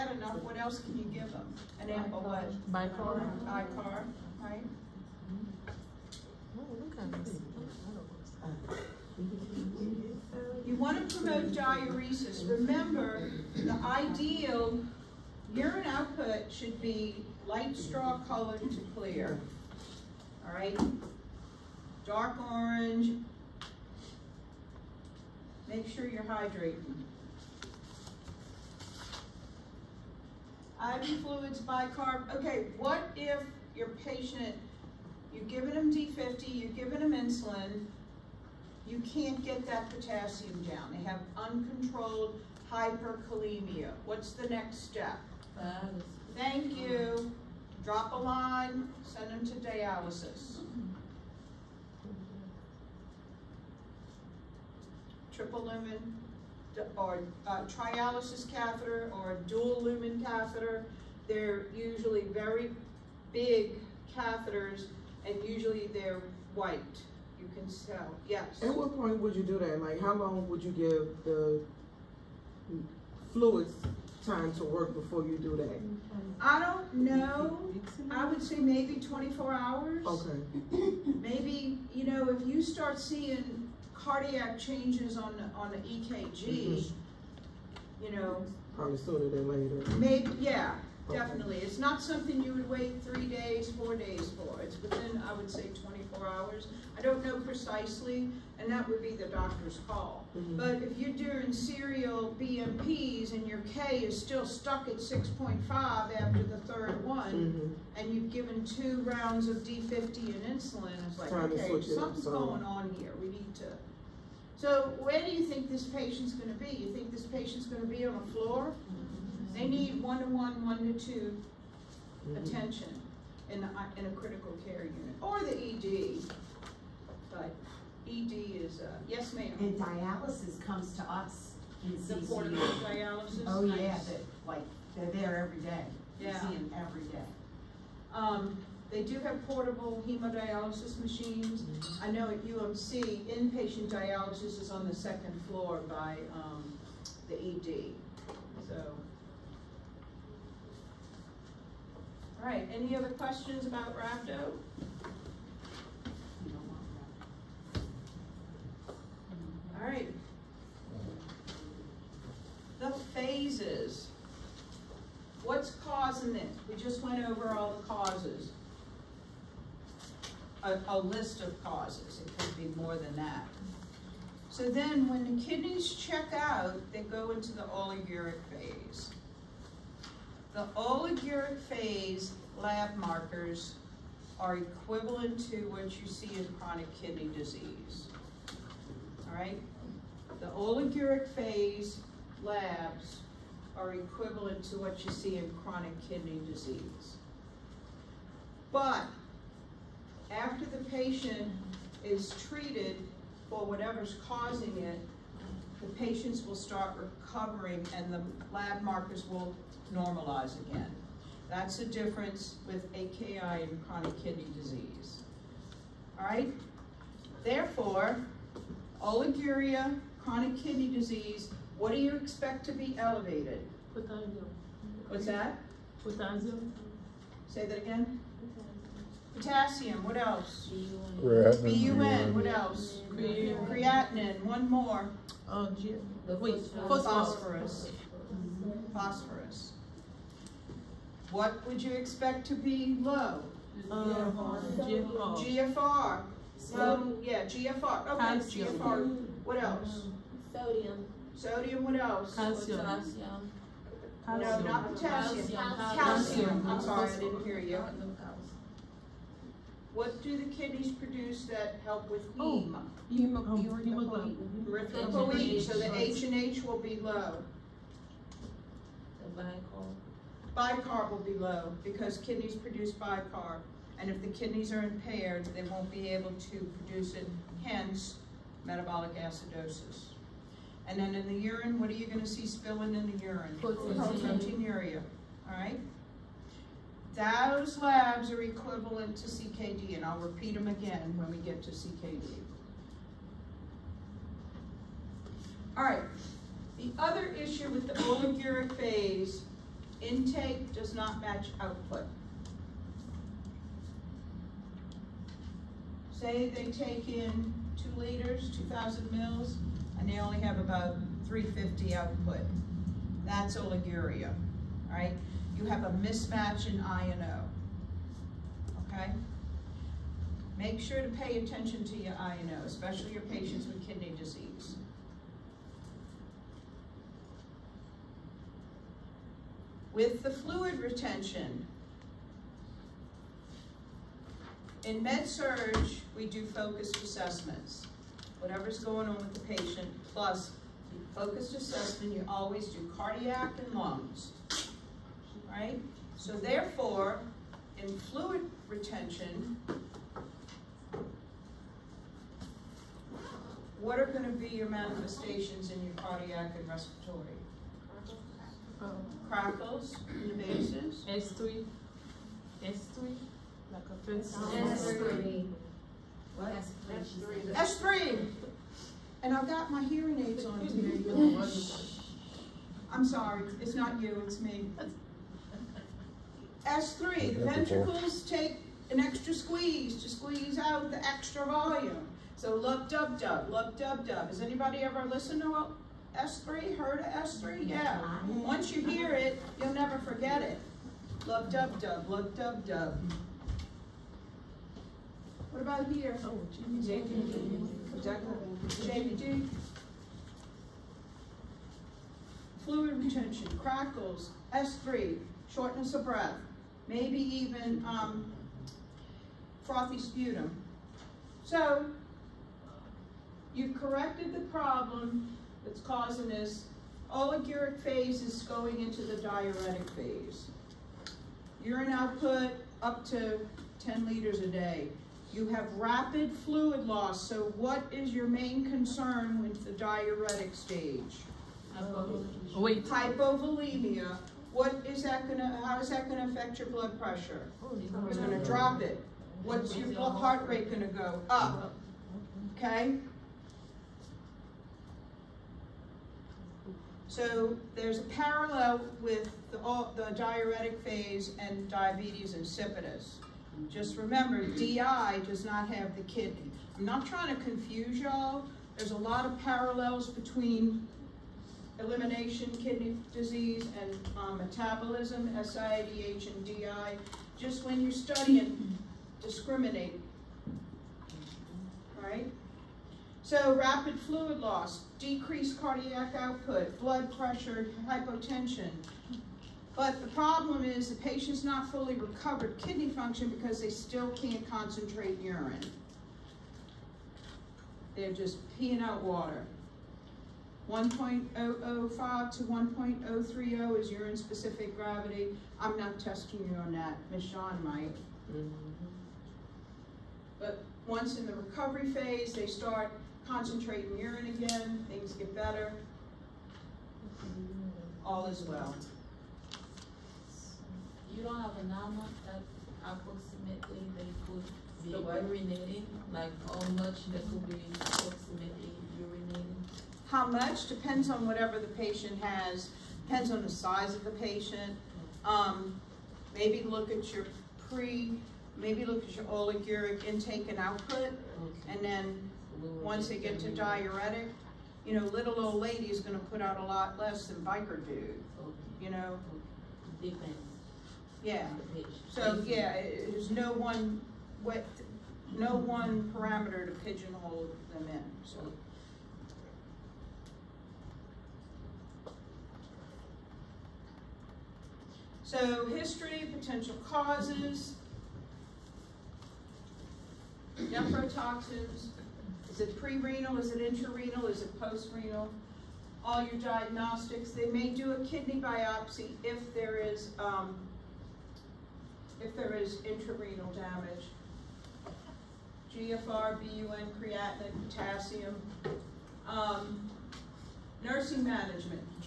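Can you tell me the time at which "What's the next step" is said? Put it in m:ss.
0:44.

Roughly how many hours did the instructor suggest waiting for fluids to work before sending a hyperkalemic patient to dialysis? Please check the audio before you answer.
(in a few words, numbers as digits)
24 hours.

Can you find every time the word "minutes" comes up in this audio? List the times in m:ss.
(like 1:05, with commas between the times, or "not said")
not said.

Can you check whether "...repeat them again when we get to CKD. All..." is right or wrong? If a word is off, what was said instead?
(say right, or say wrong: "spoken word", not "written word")
right.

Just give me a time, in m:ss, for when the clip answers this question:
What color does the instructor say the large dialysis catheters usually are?
1:05.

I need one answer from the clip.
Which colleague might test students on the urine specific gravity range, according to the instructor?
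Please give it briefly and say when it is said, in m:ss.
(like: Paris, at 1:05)
Miss Sean, at 8:17.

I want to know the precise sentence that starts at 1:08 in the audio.
At what point would you do that?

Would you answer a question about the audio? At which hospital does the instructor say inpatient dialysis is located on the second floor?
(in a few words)
UMC.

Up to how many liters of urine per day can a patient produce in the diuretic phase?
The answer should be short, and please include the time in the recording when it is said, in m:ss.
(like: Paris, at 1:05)
10 liters, at 7:03.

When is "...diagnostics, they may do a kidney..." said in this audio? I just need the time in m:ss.
9:26.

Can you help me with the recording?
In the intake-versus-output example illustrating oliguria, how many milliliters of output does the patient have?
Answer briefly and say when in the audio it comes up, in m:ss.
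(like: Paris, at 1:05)
350, at 5:11.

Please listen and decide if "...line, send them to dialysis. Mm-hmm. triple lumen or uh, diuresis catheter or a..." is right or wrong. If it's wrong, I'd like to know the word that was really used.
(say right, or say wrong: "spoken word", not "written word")
wrong: "trialysis", not "diuresis".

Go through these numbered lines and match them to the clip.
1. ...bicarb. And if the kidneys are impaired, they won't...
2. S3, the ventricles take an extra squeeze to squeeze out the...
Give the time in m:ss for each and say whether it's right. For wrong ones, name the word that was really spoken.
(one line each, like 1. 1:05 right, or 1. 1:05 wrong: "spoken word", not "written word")
1. 4:32 right
2. 6:16 right.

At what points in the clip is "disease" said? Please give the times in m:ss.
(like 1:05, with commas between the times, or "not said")
3:07, 3:16, 3:34, 3:40, 5:24, 7:43.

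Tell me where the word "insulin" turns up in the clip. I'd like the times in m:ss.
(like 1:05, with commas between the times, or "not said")
0:37, 1:50.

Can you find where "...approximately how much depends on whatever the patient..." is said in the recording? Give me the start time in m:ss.
8:37.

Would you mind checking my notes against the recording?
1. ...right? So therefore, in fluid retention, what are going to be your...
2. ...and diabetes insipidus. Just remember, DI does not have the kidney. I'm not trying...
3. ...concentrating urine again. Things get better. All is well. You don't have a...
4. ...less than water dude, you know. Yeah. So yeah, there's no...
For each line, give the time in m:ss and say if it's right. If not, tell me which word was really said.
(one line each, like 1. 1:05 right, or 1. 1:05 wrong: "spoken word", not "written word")
1. 5:45 right
2. 7:31 right
3. 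8:23 right
4. 8:56 wrong: "biker", not "water".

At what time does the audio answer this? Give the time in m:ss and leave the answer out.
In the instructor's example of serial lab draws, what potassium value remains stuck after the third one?
1:45.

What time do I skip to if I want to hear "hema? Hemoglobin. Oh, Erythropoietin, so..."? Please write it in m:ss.
4:22.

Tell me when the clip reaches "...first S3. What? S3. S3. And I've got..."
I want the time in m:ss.
6:04.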